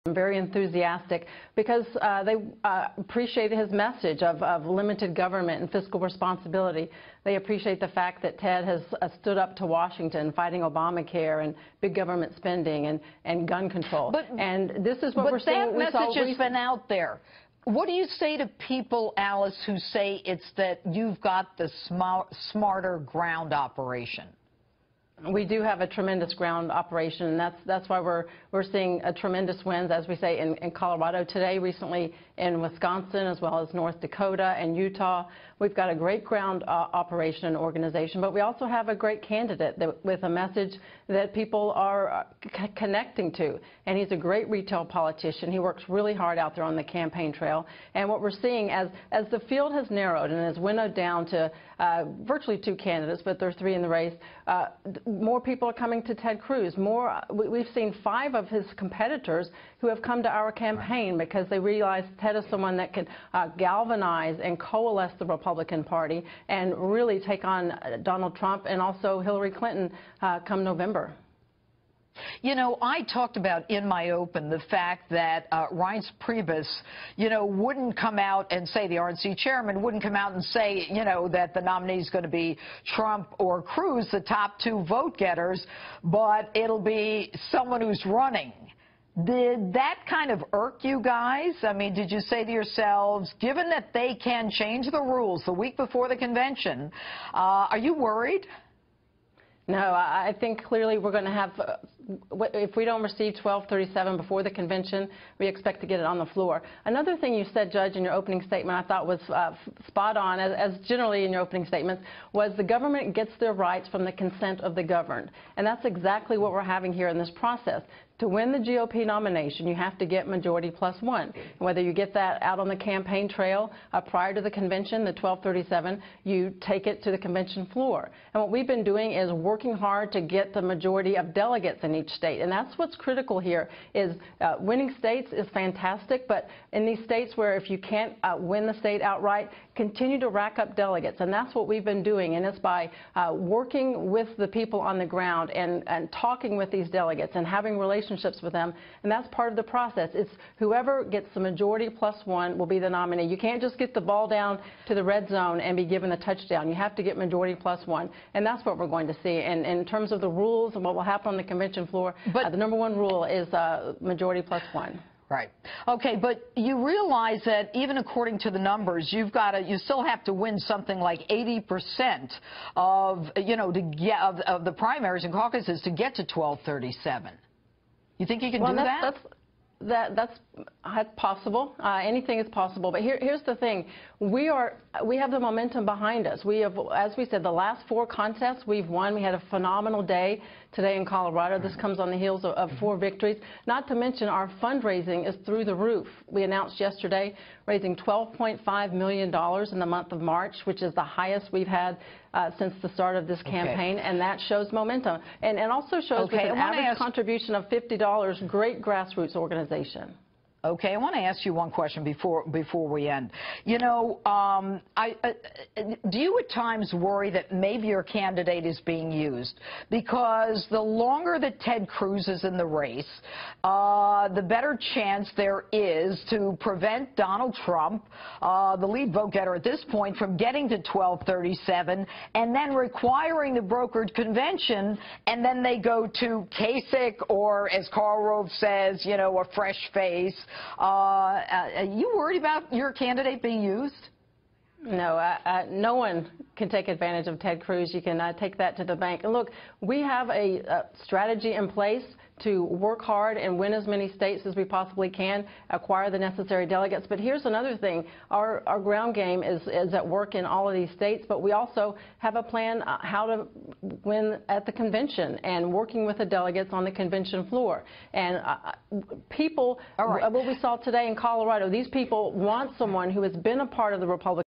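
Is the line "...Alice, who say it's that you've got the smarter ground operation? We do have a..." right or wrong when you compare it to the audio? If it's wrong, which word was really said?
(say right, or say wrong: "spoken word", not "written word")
right.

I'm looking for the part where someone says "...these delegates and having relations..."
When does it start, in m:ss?
2:26.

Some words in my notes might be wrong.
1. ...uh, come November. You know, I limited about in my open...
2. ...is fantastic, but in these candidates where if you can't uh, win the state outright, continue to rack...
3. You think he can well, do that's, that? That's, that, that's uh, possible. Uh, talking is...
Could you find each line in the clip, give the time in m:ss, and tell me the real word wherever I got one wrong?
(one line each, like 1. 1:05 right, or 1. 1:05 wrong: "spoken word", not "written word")
1. 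1:10 wrong: "talked", not "limited"
2. 2:15 wrong: "states", not "candidates"
3. 2:58 wrong: "anything", not "talking".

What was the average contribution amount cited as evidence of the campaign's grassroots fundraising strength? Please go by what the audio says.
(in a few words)
$50.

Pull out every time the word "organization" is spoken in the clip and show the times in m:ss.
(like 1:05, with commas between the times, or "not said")
0:37, 3:29.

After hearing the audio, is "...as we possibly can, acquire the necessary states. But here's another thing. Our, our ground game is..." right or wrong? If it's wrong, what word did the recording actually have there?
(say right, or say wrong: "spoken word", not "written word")
wrong: "delegates", not "states".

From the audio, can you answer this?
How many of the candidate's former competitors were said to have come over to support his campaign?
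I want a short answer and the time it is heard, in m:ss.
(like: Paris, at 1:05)
5, at 0:58.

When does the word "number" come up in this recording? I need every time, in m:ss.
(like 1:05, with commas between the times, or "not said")
2:42, 2:48.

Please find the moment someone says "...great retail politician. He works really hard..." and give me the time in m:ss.
0:44.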